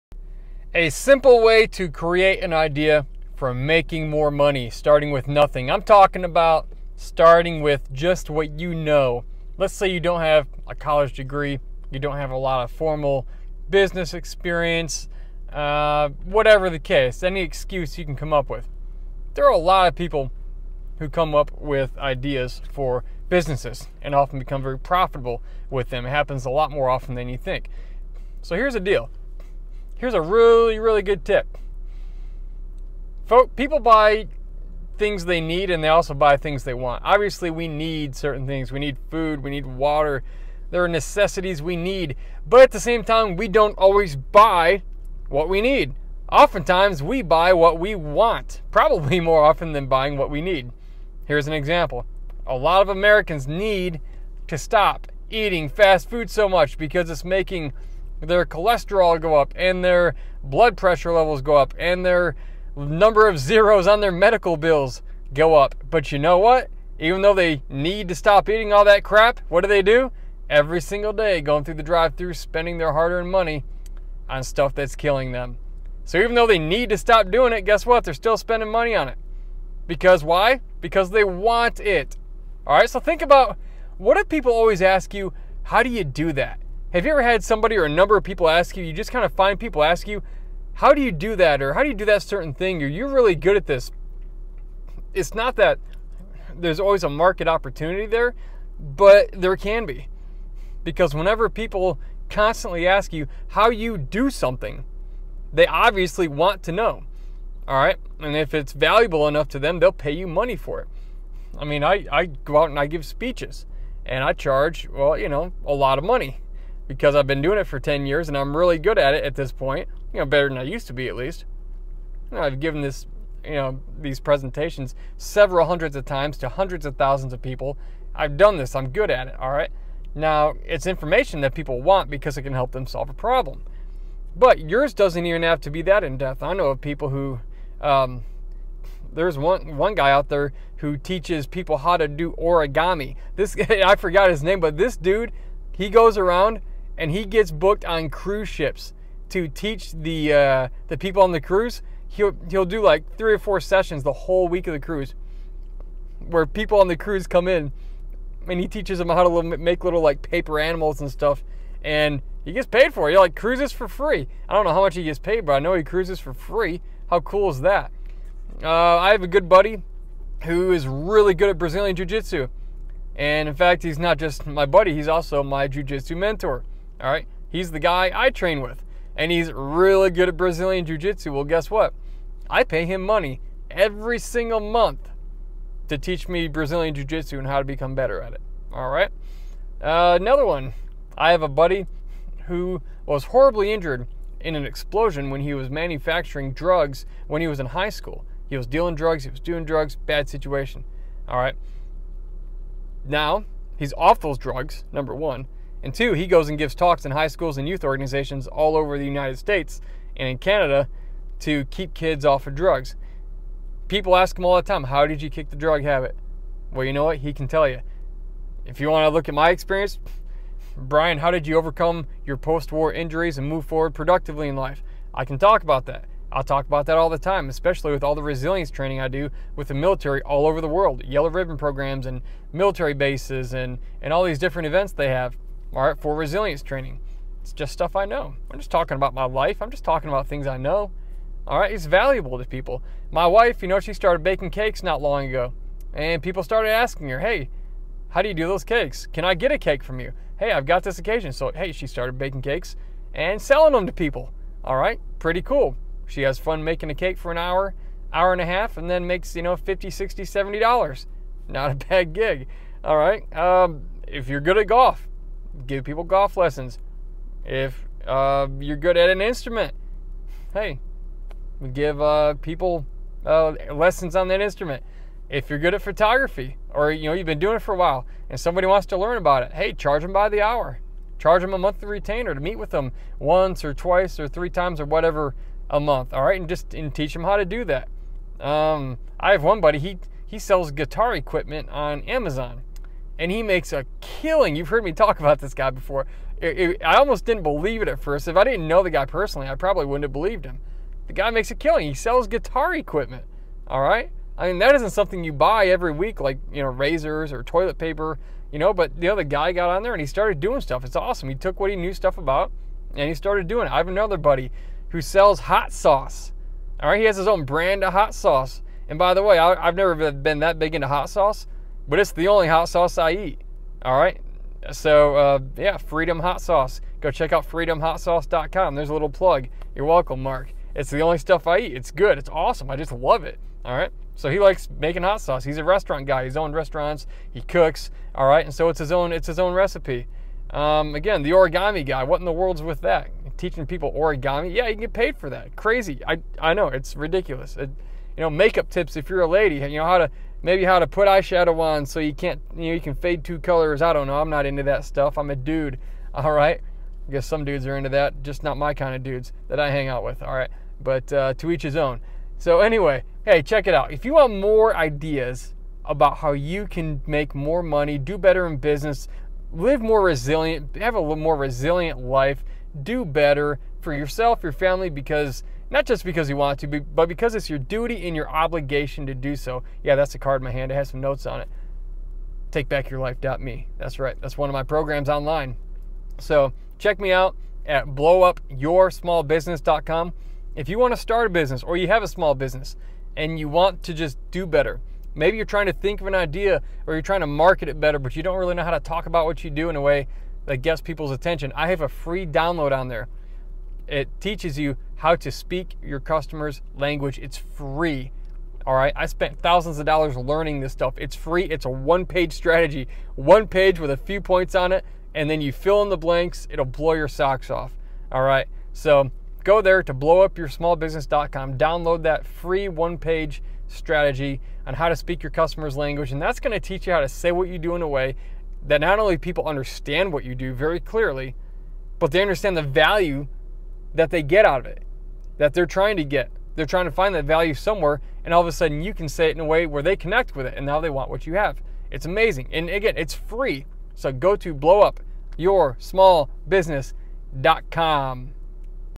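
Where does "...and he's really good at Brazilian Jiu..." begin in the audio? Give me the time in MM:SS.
02:59.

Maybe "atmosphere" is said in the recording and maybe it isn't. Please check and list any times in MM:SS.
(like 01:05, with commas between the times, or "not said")
not said.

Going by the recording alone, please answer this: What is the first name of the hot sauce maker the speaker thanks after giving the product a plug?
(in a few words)
Mark.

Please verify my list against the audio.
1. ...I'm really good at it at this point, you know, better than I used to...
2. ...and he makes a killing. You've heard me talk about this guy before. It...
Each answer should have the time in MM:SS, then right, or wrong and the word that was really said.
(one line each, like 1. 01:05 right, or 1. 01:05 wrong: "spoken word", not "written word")
1. 01:58 right
2. 04:53 right.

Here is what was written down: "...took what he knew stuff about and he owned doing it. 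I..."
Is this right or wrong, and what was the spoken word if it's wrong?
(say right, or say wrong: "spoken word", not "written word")
wrong: "started", not "owned".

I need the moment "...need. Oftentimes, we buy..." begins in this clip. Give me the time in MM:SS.
00:45.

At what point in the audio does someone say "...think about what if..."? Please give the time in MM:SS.
01:22.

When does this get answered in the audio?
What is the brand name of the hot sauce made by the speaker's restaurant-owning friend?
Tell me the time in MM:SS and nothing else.
05:25.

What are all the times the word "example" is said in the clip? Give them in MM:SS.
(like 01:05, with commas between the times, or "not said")
00:51.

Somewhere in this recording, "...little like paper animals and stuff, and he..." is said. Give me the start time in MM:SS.
02:39.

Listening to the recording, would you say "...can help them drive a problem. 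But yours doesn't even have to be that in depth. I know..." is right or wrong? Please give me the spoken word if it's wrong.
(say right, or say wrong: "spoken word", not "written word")
wrong: "solve", not "drive".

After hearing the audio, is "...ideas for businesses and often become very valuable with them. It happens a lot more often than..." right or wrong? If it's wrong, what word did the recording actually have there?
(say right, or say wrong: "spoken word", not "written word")
wrong: "profitable", not "valuable".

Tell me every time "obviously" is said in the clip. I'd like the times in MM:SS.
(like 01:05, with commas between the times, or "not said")
00:37, 01:45.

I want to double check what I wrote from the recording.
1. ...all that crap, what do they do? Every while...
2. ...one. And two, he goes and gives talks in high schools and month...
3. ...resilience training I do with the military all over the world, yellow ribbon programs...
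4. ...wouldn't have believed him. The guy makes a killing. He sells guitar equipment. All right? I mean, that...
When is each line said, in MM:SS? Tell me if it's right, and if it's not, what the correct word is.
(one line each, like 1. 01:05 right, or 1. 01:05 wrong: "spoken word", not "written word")
1. 01:08 wrong: "single", not "while"
2. 03:25 wrong: "youth", not "month"
3. 03:48 right
4. 04:59 right.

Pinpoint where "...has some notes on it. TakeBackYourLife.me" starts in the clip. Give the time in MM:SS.
06:20.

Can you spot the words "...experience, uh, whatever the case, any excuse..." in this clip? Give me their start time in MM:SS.
00:14.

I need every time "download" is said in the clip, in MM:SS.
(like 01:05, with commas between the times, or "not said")
06:42, 07:01.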